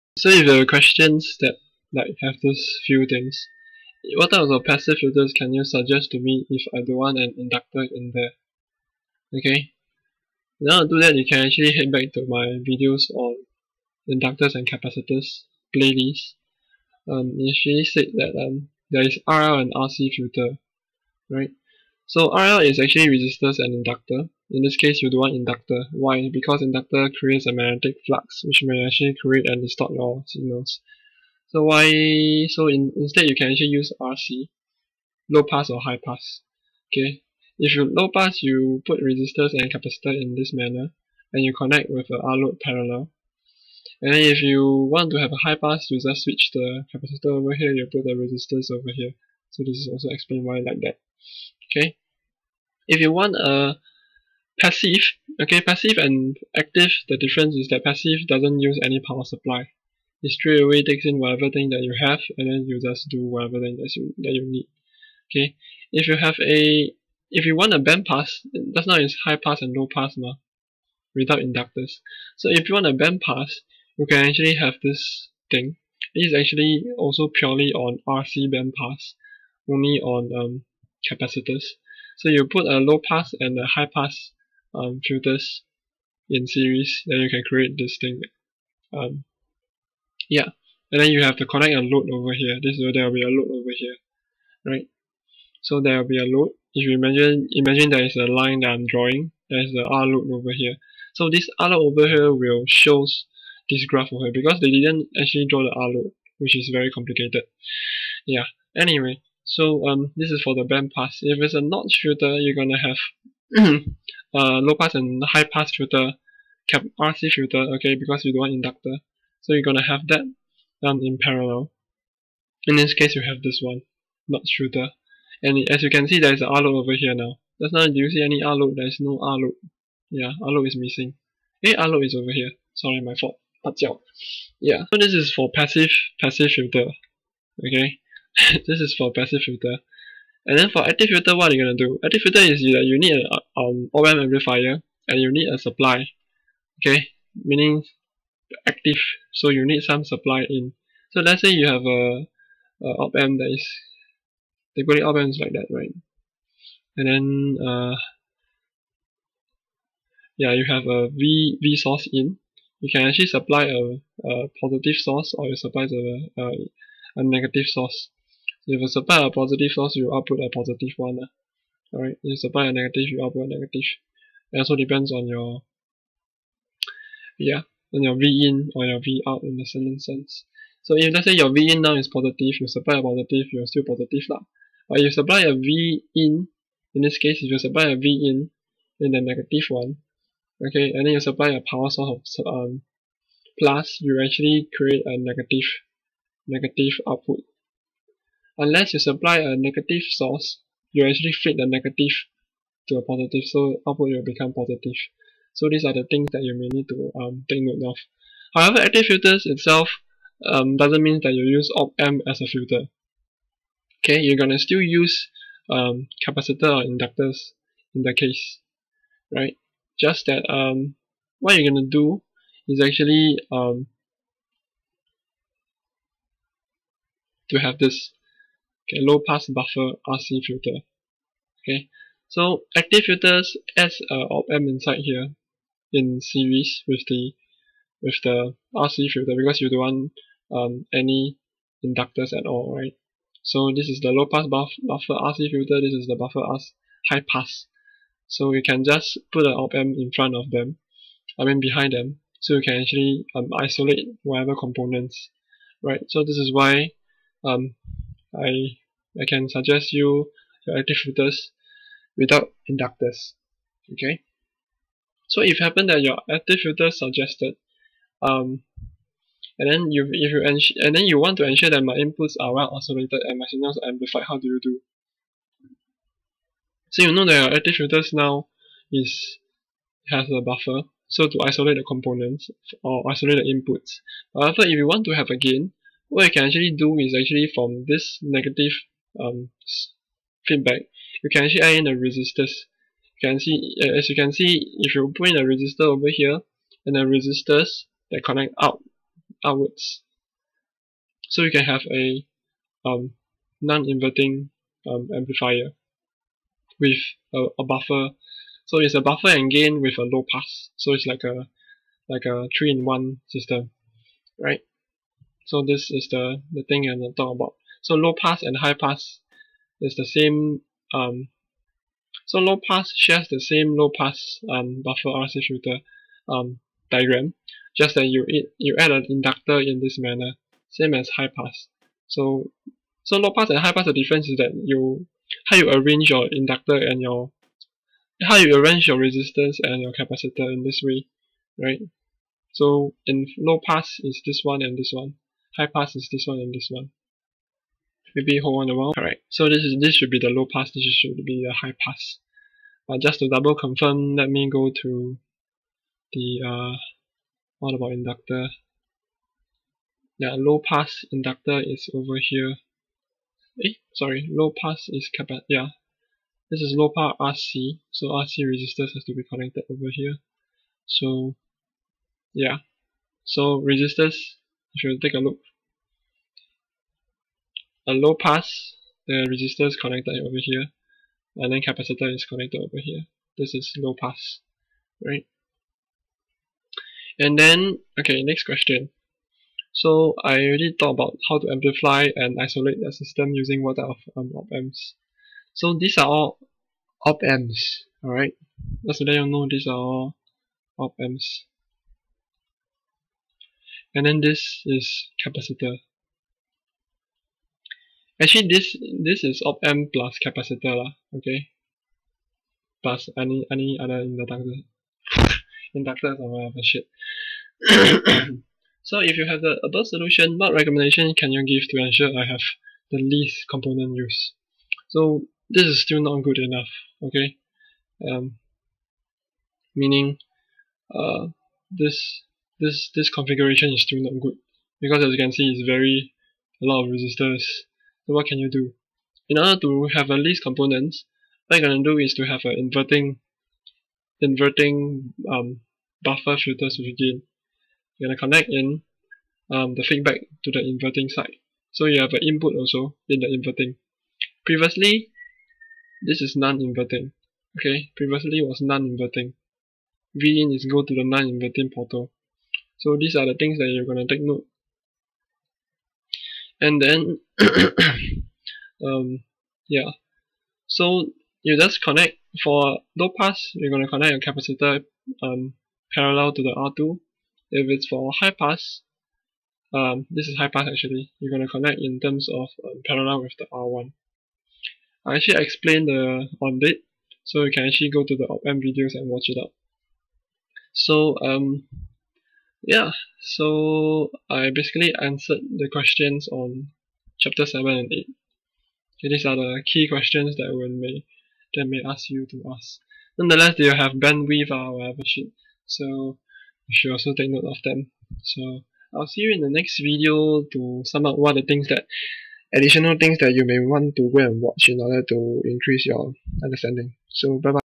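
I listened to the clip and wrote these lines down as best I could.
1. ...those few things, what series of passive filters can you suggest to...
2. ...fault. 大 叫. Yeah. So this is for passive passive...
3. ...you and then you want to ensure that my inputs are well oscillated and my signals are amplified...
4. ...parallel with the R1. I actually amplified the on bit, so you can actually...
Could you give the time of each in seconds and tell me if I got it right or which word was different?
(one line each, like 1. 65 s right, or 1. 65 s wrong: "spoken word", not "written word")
1. 2 s wrong: "types", not "series"
2. 133 s right
3. 270 s right
4. 482 s wrong: "explained", not "amplified".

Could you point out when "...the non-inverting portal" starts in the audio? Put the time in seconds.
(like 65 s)
460 s.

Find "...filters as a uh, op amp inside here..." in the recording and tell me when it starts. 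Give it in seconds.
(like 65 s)
233 s.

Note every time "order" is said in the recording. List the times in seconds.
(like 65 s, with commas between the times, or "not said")
439 s, 514 s.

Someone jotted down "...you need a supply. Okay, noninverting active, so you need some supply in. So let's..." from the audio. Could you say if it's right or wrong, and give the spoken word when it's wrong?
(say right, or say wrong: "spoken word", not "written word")
wrong: "meaning", not "noninverting".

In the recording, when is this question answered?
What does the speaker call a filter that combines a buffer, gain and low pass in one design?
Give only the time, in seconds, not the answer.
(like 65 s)
312 s.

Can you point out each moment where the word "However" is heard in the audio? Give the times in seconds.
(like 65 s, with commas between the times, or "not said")
208 s, 284 s.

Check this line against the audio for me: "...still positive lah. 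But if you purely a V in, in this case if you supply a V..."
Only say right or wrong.
wrong.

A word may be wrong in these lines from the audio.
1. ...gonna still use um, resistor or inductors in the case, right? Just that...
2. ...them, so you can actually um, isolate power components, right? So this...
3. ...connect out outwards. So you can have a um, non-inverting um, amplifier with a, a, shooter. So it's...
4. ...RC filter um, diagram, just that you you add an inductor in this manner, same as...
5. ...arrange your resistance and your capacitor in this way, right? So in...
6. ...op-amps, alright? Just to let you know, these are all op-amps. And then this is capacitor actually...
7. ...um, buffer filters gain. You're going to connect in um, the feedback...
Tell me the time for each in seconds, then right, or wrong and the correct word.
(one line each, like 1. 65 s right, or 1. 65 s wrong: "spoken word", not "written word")
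1. 214 s wrong: "capacitor", not "resistor"
2. 251 s wrong: "whatever", not "power"
3. 298 s wrong: "buffer", not "shooter"
4. 325 s right
5. 338 s right
6. 397 s right
7. 445 s right.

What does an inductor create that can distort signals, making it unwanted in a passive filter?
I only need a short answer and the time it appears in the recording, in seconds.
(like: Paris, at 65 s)
magnetic flux, at 27 s.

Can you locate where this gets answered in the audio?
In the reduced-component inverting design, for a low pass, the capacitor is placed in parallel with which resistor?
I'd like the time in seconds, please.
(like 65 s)
476 s.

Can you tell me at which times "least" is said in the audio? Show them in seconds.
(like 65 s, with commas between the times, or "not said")
423 s, 440 s.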